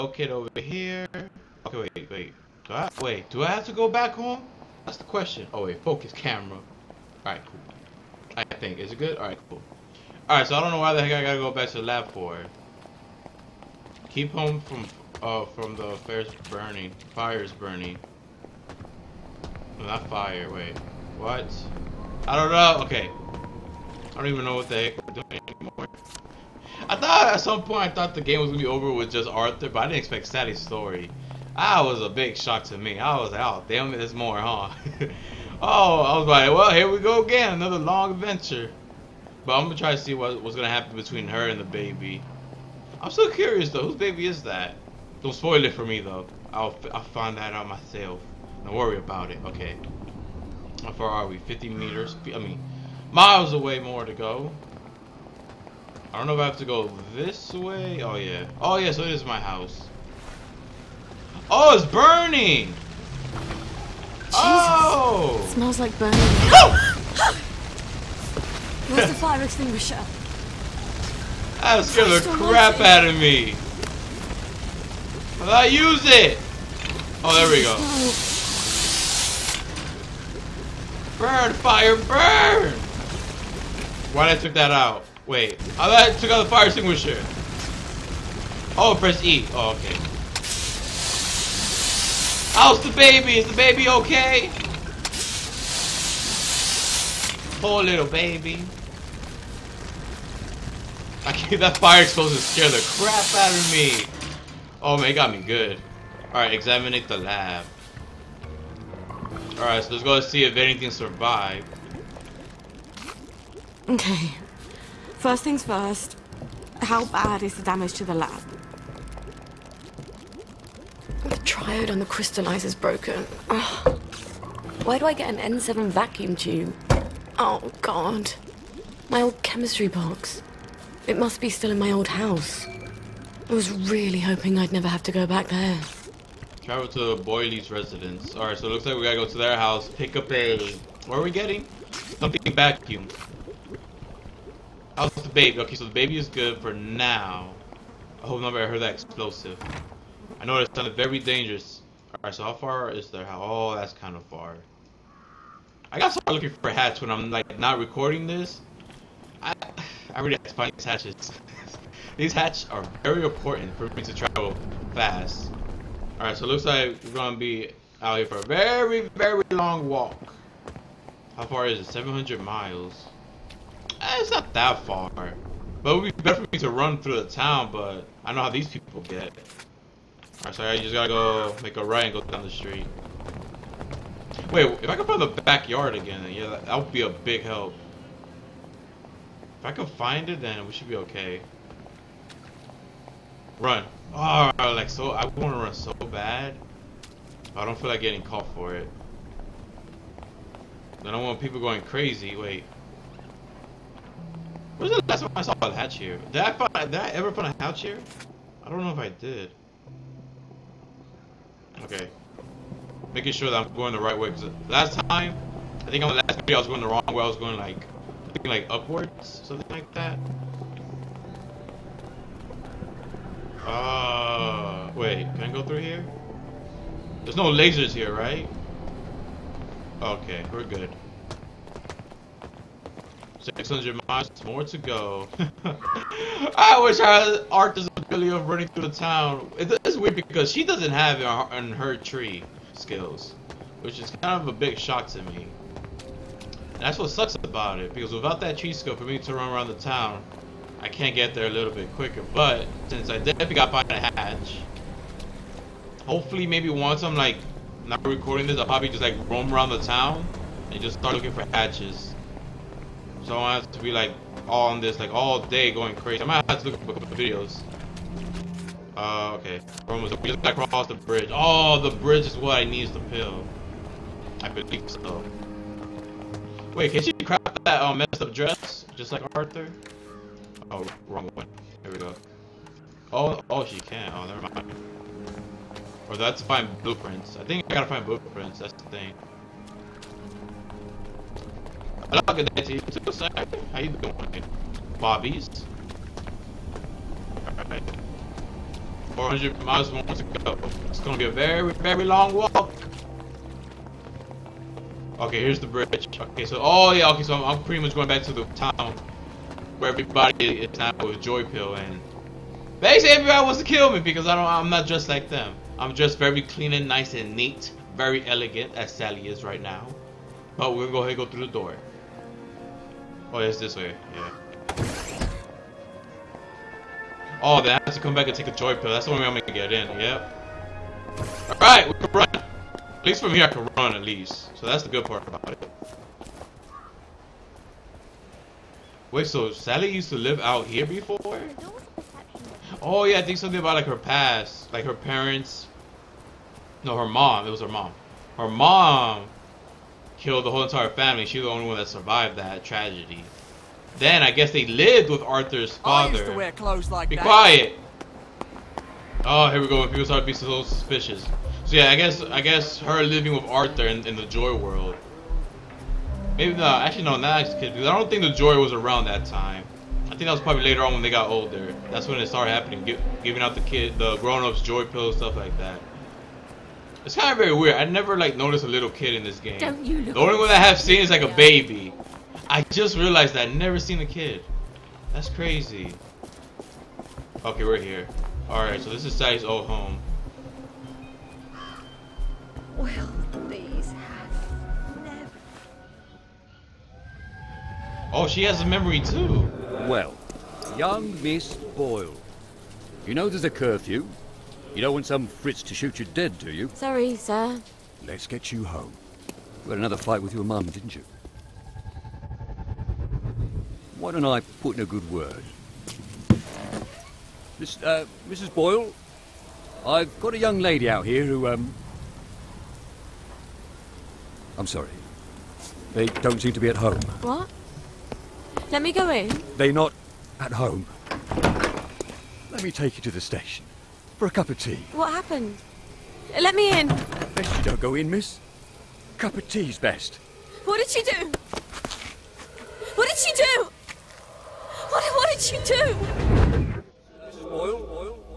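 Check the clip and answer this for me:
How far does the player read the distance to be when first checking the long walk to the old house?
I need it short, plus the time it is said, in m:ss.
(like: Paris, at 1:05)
700 miles, at 2:51.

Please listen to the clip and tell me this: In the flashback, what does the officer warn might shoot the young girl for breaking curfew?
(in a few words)
Fritz.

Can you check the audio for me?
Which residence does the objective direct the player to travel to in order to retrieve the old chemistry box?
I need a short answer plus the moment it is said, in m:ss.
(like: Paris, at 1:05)
Boyle's residence, at 2:17.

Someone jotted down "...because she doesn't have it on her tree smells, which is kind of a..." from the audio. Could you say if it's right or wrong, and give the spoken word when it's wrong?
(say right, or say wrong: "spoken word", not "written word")
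wrong: "skills", not "smells".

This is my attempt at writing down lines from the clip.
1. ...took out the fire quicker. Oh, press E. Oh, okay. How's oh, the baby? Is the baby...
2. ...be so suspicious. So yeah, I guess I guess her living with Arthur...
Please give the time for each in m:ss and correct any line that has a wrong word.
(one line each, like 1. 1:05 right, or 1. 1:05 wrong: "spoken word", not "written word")
1. 1:26 wrong: "extinguisher", not "quicker"
2. 6:00 right.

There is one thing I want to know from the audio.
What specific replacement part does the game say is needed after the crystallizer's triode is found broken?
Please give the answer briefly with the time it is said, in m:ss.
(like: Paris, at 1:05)
N7 vacuum tube, at 2:05.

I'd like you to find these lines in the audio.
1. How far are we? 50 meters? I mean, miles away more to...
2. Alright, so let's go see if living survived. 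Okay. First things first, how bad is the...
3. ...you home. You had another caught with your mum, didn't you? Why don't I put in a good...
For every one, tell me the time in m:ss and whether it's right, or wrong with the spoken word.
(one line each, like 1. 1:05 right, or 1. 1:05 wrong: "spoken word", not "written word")
1. 0:50 right
2. 1:49 wrong: "anything", not "living"
3. 6:48 wrong: "fight", not "caught".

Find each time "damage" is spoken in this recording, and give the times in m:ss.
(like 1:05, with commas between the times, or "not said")
1:57.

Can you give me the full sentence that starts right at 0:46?
I'll, I'll find that out myself.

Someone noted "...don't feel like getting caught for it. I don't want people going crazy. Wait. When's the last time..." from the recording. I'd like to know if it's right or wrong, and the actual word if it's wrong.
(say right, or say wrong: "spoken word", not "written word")
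right.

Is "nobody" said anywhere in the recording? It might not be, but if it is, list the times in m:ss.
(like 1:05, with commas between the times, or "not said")
2:28.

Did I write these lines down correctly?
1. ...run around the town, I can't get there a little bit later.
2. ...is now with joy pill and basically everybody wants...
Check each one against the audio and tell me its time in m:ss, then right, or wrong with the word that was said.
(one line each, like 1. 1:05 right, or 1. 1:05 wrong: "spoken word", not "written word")
1. 4:09 wrong: "quicker", not "later"
2. 5:10 right.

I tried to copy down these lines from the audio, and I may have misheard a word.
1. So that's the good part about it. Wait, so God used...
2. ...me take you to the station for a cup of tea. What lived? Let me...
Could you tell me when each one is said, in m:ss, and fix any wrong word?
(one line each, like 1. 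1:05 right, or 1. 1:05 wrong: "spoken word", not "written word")
1. 5:34 wrong: "Sally", not "God"
2. 7:12 wrong: "happened", not "lived".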